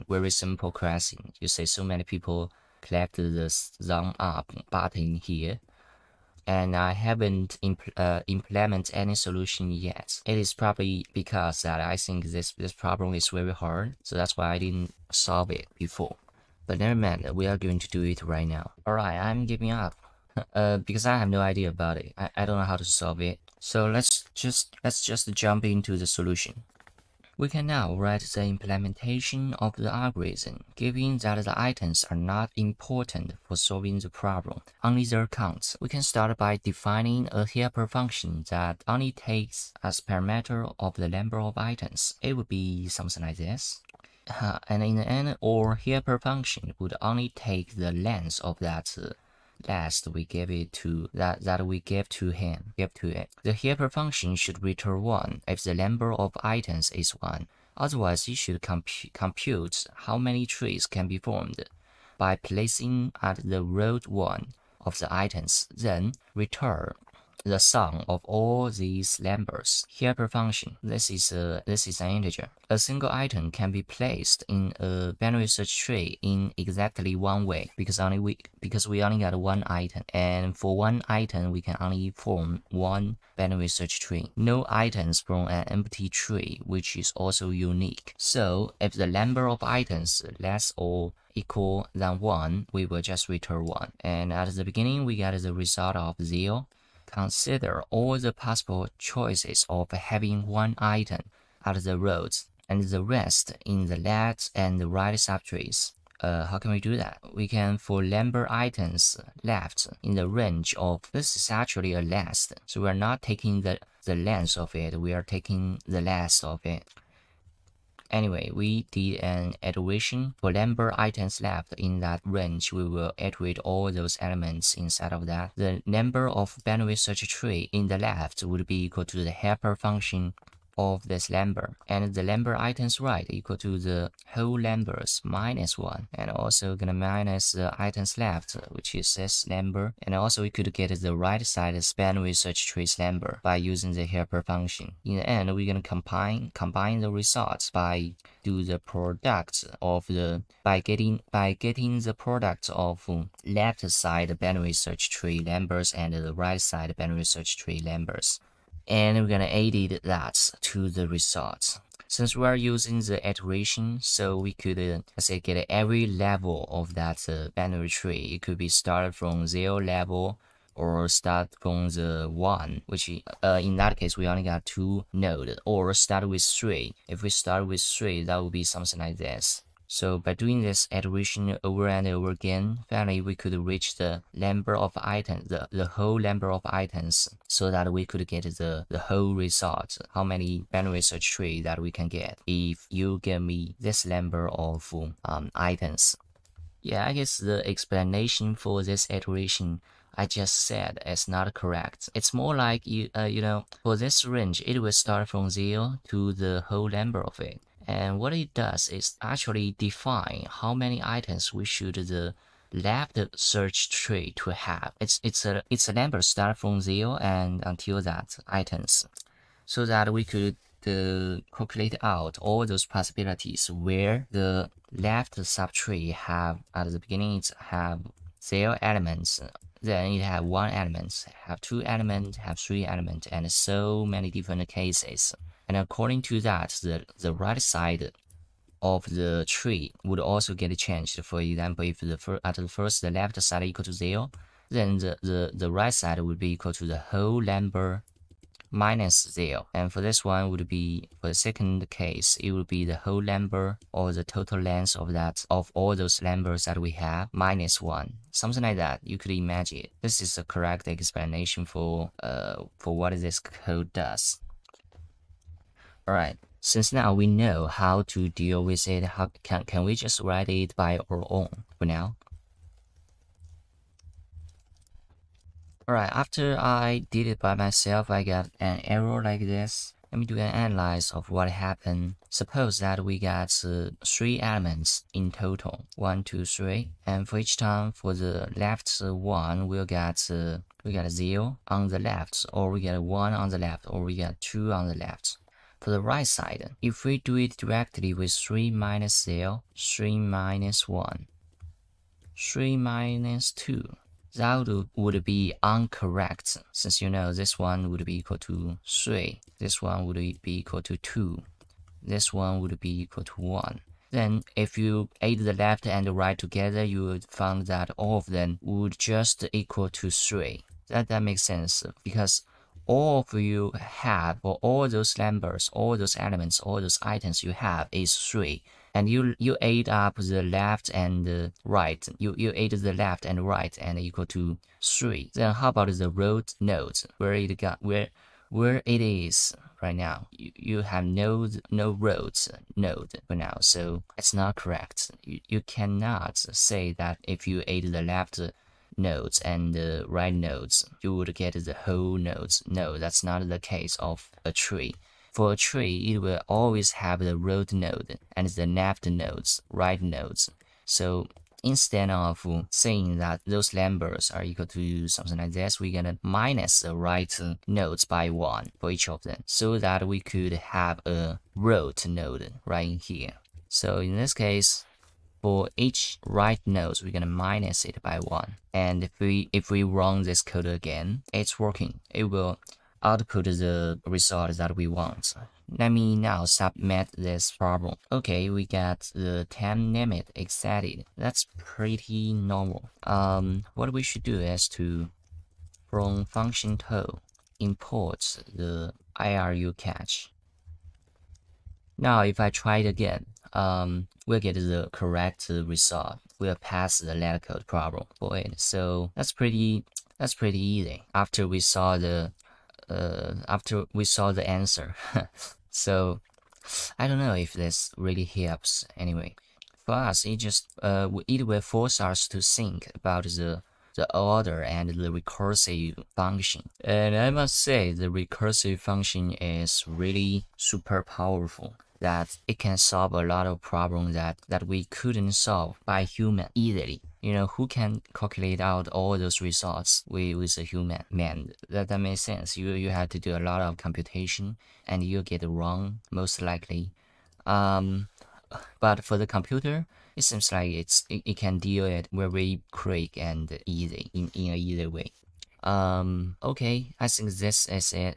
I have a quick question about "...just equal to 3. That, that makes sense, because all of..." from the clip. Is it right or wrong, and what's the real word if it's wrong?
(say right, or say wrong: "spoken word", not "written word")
right.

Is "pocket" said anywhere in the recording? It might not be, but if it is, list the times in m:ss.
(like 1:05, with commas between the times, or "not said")
not said.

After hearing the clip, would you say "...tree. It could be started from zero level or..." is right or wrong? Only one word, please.
right.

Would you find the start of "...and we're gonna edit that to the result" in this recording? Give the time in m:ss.
2:38.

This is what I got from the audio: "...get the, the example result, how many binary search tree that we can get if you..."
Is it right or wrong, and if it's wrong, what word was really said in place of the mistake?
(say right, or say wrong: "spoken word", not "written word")
wrong: "whole", not "example".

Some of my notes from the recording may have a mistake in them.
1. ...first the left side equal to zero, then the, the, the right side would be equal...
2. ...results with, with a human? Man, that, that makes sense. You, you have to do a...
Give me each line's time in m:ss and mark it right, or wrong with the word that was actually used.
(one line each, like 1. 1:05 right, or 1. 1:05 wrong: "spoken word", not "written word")
1. 4:02 right
2. 7:19 right.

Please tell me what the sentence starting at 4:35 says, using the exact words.
Alright, after I did it by myself, I got an error like this.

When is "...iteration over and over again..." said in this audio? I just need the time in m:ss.
3:00.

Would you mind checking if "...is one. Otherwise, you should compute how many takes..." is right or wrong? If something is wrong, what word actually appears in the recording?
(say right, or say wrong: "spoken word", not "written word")
wrong: "trees", not "takes".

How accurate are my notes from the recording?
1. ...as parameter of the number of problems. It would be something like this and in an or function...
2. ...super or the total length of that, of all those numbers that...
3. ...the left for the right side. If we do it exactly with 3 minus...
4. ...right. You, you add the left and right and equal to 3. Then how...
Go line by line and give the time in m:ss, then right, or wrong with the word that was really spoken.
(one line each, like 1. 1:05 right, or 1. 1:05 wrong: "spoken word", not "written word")
1. 0:39 wrong: "items", not "problems"
2. 4:13 wrong: "number", not "super"
3. 4:54 wrong: "directly", not "exactly"
4. 5:31 right.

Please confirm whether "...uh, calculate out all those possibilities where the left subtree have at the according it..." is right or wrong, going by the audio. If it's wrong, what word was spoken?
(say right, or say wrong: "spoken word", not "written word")
wrong: "beginning", not "according".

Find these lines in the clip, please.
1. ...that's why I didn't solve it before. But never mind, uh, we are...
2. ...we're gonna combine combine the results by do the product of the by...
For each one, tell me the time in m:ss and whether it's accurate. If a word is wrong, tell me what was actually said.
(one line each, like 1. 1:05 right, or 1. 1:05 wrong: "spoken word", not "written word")
1. 0:14 right
2. 2:25 right.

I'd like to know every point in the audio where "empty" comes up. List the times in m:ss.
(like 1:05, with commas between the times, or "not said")
1:25.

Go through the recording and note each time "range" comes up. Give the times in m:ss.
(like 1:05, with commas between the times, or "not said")
1:50, 2:02, 3:24.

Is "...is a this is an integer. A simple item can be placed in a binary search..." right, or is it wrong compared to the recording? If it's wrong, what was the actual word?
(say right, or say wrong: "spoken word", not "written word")
wrong: "single", not "simple".